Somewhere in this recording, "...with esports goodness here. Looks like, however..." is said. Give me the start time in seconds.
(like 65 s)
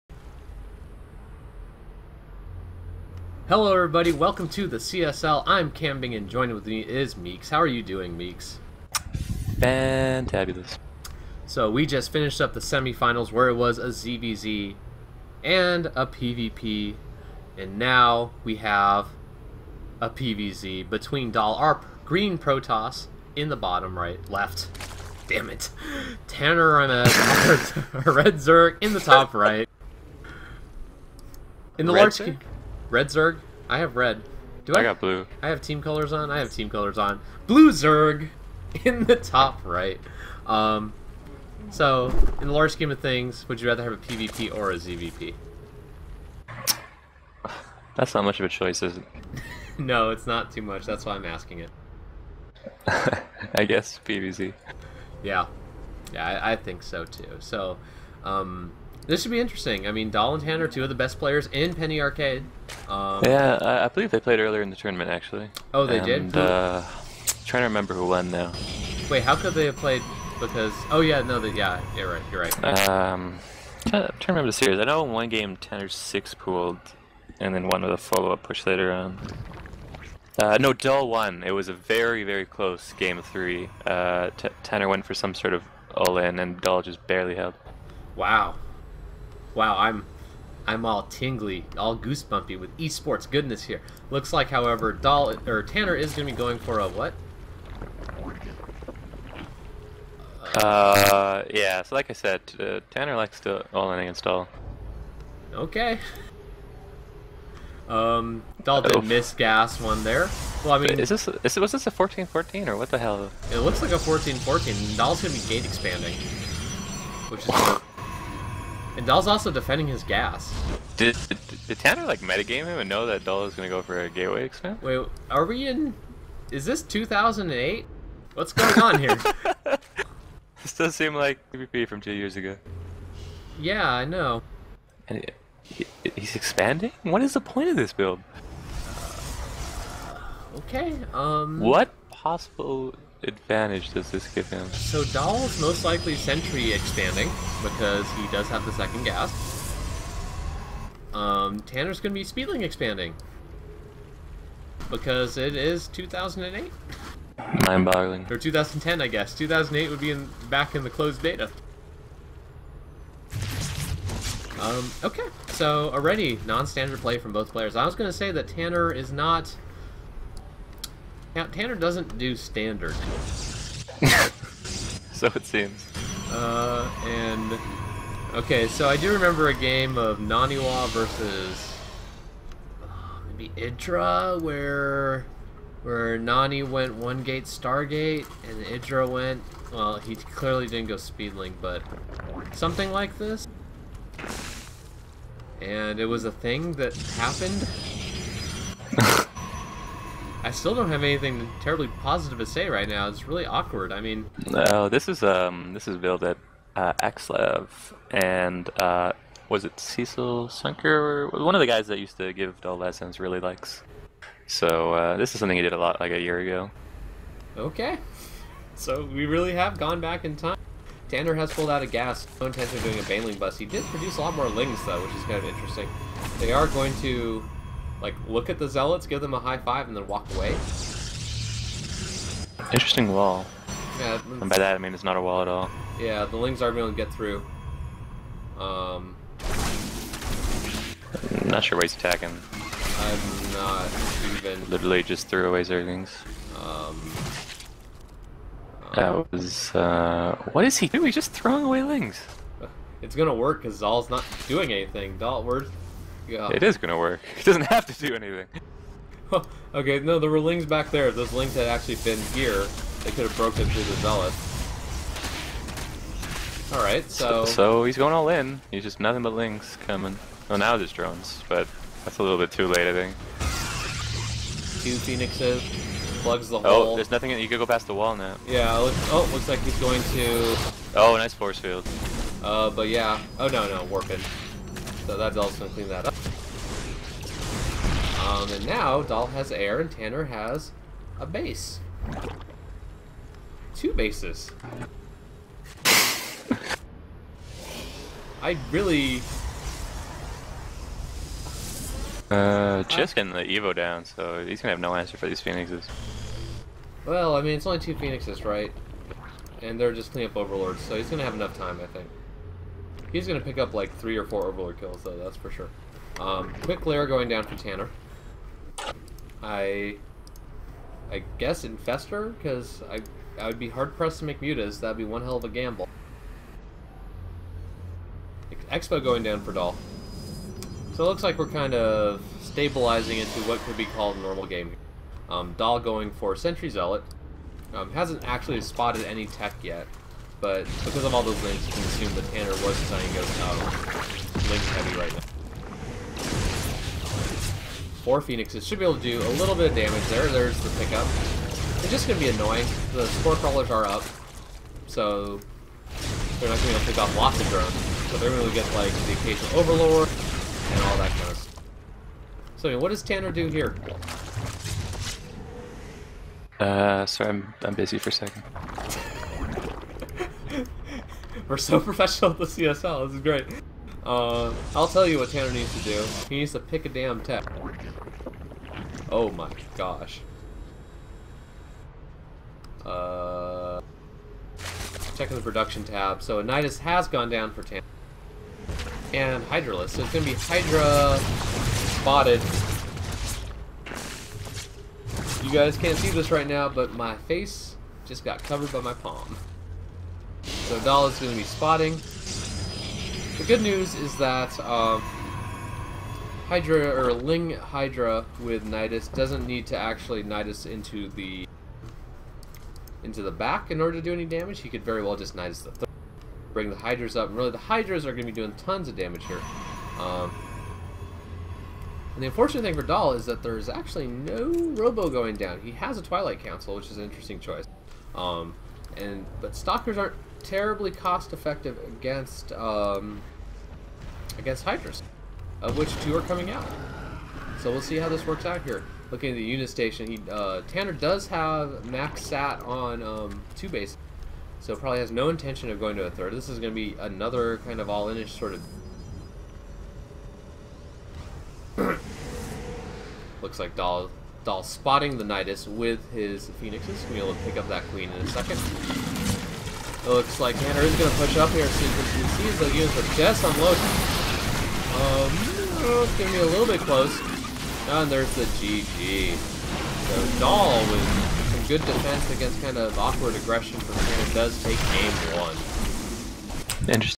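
92 s.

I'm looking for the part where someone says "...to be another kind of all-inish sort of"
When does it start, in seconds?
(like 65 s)
446 s.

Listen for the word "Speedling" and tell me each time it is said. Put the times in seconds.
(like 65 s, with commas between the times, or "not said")
152 s, 190 s.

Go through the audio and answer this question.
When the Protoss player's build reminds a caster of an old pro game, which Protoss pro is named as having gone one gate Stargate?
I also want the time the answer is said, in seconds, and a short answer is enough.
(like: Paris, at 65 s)
Naniwa, at 180 s.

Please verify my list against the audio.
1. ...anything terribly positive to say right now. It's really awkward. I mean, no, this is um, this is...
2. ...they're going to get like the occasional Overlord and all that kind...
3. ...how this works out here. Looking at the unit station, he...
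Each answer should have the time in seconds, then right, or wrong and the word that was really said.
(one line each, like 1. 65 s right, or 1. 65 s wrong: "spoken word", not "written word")
1. 201 s right
2. 358 s right
3. 437 s right.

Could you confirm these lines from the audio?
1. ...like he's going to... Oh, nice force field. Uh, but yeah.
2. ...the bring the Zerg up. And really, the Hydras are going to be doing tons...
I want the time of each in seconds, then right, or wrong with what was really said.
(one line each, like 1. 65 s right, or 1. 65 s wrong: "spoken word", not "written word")
1. 279 s right
2. 415 s wrong: "Hydras", not "Zerg".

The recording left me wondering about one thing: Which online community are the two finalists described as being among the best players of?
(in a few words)
Penny Arcade.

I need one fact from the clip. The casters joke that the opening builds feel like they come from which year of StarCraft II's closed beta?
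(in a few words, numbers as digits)
2008.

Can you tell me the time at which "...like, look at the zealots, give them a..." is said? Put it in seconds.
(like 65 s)
228 s.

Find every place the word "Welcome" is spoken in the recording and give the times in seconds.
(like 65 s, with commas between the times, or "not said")
4 s.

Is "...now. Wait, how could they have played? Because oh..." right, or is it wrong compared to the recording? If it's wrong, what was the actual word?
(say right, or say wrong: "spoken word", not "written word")
right.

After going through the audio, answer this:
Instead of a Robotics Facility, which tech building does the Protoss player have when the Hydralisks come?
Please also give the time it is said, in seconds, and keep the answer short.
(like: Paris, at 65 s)
Twilight Council, at 426 s.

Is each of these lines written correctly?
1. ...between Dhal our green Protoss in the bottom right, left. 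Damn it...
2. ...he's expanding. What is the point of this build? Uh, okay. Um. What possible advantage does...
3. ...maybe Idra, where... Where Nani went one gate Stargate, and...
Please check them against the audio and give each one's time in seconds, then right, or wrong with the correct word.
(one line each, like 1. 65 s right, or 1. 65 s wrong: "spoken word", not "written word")
1. 20 s right
2. 136 s right
3. 183 s right.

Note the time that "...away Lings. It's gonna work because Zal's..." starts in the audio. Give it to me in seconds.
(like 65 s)
251 s.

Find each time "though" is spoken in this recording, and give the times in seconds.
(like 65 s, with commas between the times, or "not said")
224 s, 315 s.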